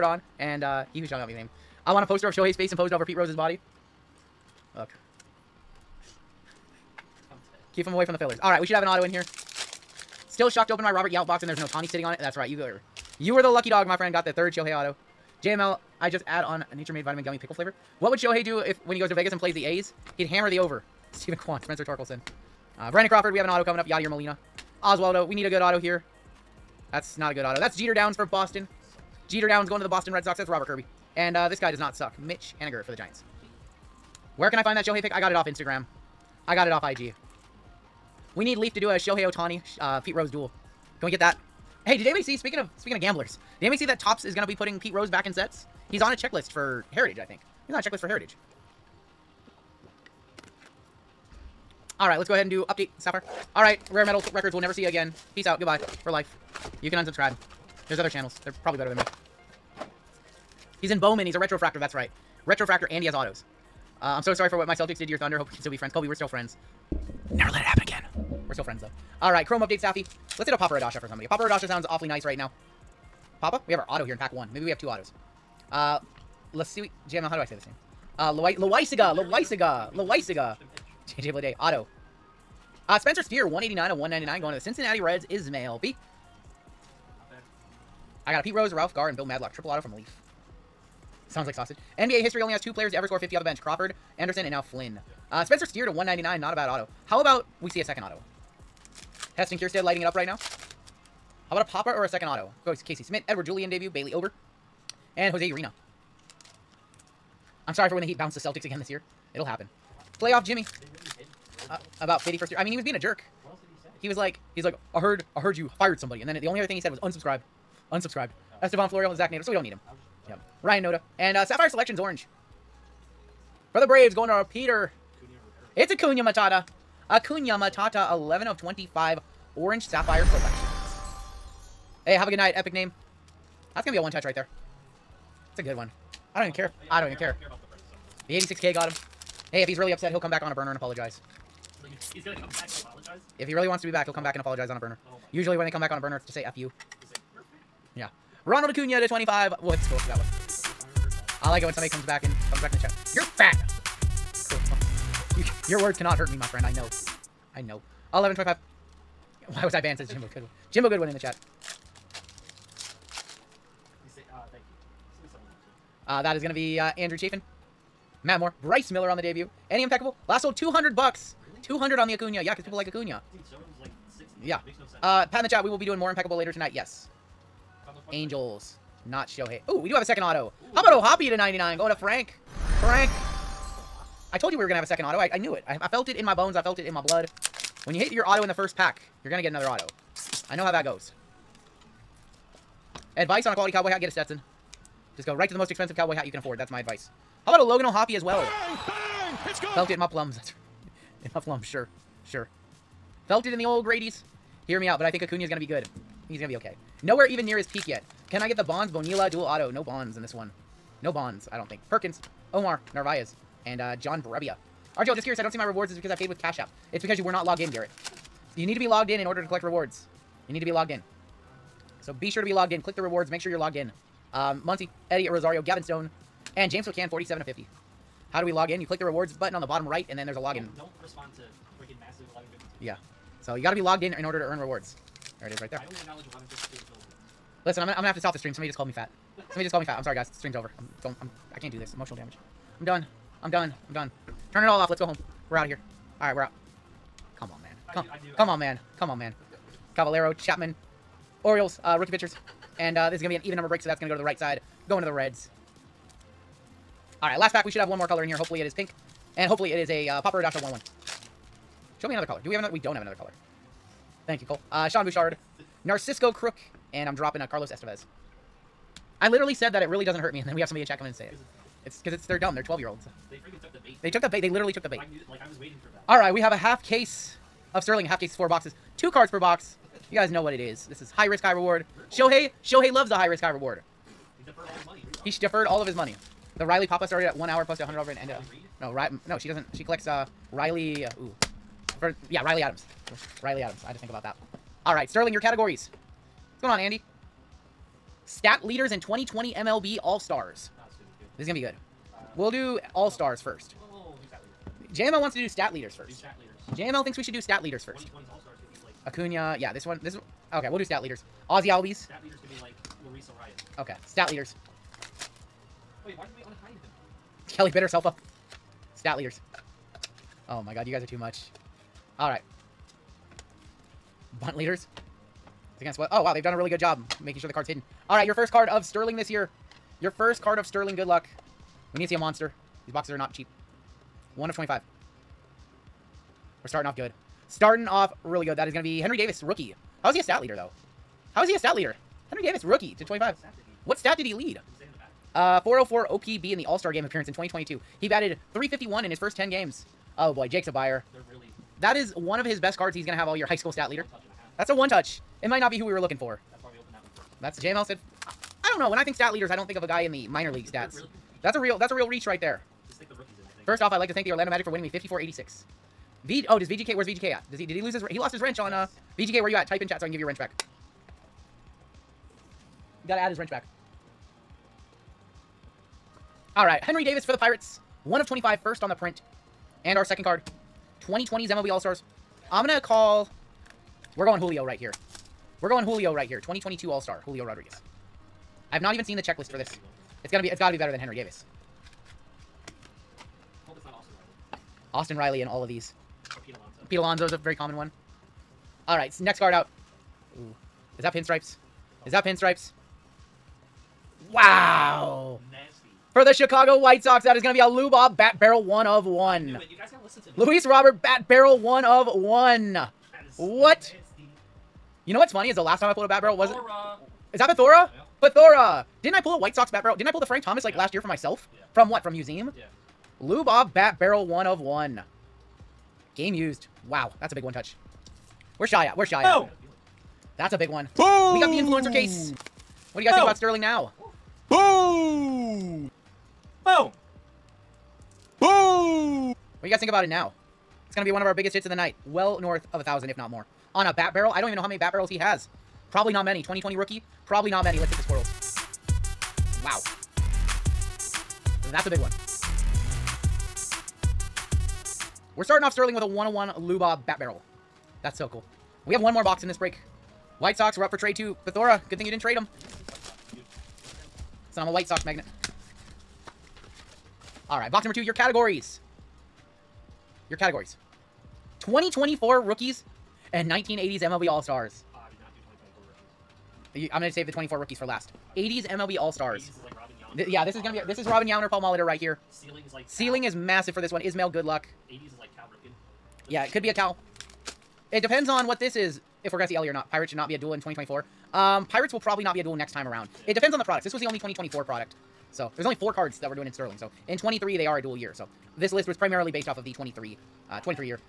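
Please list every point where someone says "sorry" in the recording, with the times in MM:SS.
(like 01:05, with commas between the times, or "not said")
01:04, 01:47, 04:00.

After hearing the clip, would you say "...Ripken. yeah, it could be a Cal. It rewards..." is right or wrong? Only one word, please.
wrong.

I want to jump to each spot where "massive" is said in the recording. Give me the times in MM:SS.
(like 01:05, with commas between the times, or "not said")
03:52, 08:03.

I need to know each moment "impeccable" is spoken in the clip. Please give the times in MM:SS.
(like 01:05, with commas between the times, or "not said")
02:49, 02:56.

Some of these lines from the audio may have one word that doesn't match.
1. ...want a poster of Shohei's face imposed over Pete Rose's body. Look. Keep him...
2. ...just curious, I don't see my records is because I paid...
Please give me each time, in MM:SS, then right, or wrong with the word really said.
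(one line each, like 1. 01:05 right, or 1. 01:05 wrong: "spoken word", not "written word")
1. 00:01 right
2. 03:35 wrong: "rewards", not "records".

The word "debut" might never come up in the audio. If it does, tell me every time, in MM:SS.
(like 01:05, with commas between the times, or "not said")
01:43, 02:49.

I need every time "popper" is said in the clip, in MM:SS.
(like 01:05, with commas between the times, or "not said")
01:41, 04:20.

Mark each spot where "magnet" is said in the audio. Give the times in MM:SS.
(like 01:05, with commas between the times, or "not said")
07:45.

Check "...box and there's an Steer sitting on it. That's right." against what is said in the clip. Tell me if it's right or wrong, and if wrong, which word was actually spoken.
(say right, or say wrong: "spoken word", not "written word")
wrong: "Ohtani", not "Steer".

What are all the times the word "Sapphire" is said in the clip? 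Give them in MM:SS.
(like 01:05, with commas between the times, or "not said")
00:52, 02:01, 02:09.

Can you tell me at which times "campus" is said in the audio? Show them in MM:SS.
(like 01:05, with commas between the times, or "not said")
not said.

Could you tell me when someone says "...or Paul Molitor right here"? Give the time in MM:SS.
08:01.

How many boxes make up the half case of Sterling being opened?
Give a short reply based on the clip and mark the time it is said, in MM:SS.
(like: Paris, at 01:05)
4, at 04:38.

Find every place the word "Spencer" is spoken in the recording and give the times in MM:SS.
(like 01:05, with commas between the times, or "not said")
00:21, 01:22, 01:35.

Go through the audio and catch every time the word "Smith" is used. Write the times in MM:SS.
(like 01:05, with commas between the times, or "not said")
01:43.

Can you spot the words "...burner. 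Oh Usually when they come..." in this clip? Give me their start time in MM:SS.
02:24.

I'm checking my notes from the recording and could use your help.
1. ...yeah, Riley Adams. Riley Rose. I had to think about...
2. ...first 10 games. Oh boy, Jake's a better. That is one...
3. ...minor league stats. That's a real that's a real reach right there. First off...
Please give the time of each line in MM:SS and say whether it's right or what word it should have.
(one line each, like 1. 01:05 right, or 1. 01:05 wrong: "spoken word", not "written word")
1. 04:52 wrong: "Adams", not "Rose"
2. 05:49 wrong: "buyer", not "better"
3. 06:00 right.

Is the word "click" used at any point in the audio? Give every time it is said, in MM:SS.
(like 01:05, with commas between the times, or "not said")
03:42, 03:48.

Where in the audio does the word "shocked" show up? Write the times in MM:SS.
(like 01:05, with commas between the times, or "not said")
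00:10.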